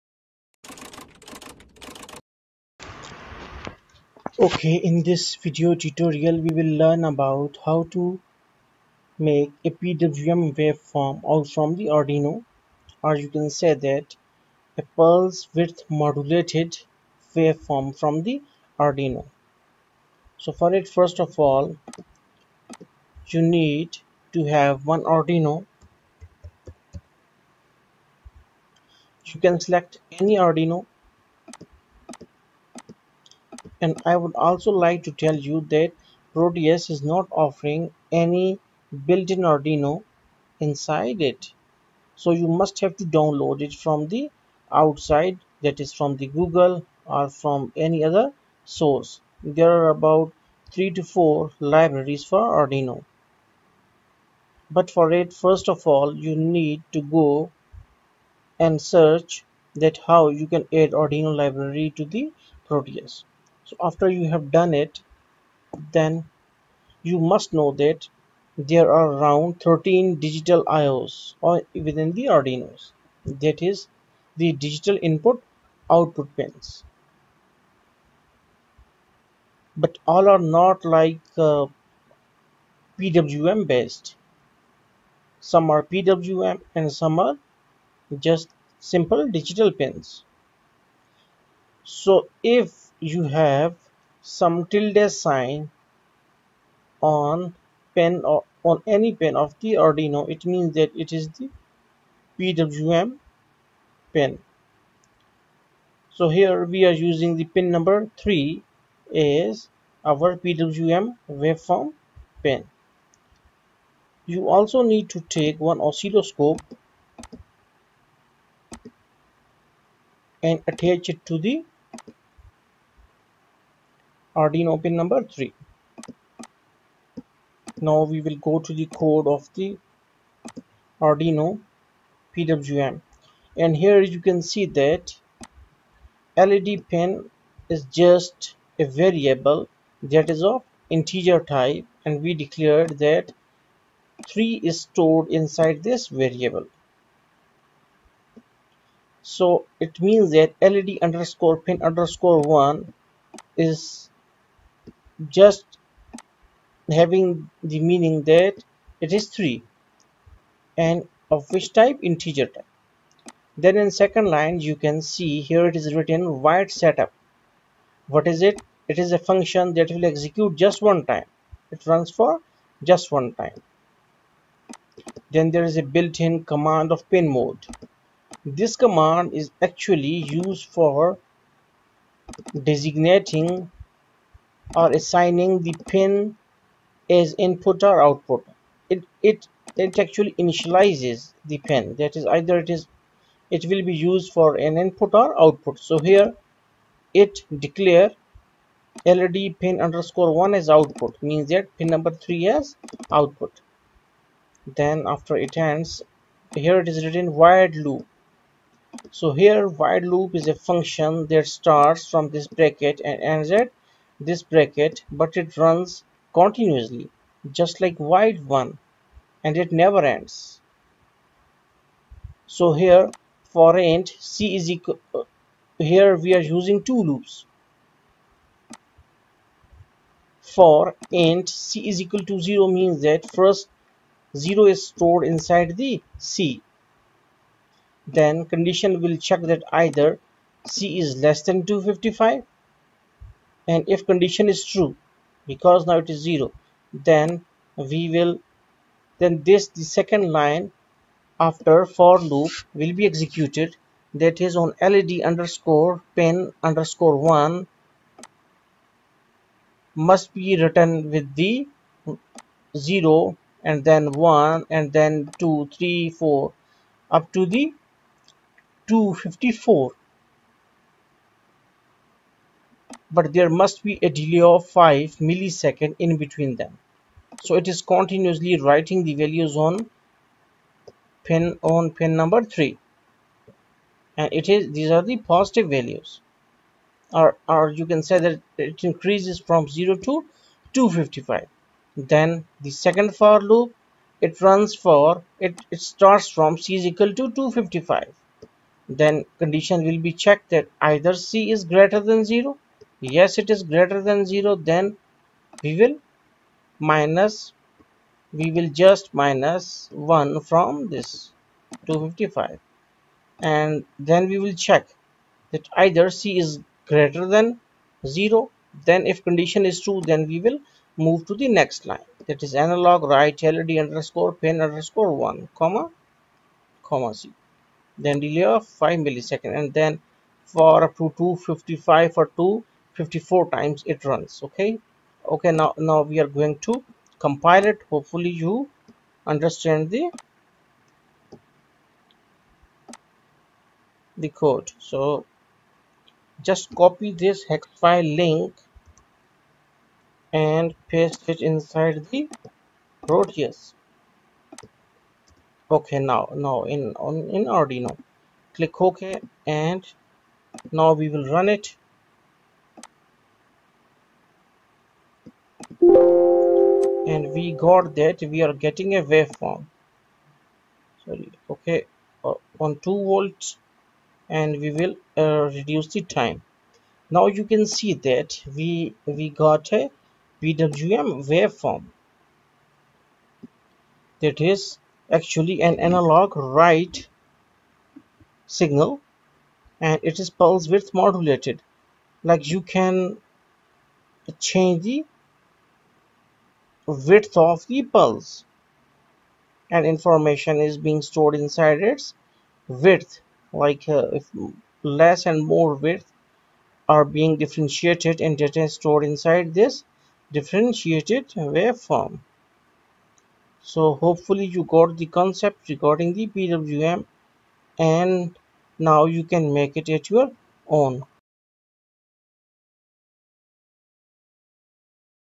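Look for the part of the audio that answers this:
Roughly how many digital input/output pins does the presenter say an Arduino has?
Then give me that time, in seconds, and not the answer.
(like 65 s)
69 s.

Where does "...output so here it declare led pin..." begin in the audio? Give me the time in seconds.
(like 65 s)
195 s.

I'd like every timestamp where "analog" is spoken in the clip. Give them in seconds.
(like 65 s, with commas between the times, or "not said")
322 s, 385 s.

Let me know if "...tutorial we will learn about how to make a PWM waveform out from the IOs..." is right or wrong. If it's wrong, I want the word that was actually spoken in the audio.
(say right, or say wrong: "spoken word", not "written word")
wrong: "Arduino", not "IOs".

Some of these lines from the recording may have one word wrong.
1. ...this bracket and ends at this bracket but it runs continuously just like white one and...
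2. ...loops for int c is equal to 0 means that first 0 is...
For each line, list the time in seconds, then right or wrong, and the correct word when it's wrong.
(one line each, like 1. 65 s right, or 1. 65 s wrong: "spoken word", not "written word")
1. 212 s right
2. 227 s right.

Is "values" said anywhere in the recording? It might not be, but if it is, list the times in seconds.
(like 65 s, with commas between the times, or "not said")
279 s, 285 s.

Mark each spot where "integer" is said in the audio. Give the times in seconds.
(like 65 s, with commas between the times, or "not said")
140 s, 162 s.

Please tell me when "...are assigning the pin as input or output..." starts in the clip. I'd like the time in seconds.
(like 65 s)
184 s.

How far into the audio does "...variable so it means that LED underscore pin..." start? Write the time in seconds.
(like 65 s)
146 s.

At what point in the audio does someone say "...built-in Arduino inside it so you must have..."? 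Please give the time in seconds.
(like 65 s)
39 s.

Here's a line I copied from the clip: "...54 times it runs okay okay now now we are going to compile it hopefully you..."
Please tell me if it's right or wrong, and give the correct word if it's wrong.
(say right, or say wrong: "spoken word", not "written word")
right.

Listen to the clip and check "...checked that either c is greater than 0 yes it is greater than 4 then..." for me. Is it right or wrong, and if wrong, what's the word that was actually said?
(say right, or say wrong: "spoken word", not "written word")
wrong: "0", not "4".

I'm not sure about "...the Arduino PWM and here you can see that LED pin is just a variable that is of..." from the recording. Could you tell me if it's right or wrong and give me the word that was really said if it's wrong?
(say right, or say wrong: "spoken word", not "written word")
right.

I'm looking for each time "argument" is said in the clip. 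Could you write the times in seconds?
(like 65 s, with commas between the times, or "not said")
not said.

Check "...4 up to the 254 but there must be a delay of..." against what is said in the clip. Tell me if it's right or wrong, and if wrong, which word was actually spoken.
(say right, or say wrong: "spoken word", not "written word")
right.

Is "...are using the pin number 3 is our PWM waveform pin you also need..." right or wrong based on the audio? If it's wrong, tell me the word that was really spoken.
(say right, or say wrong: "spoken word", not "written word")
right.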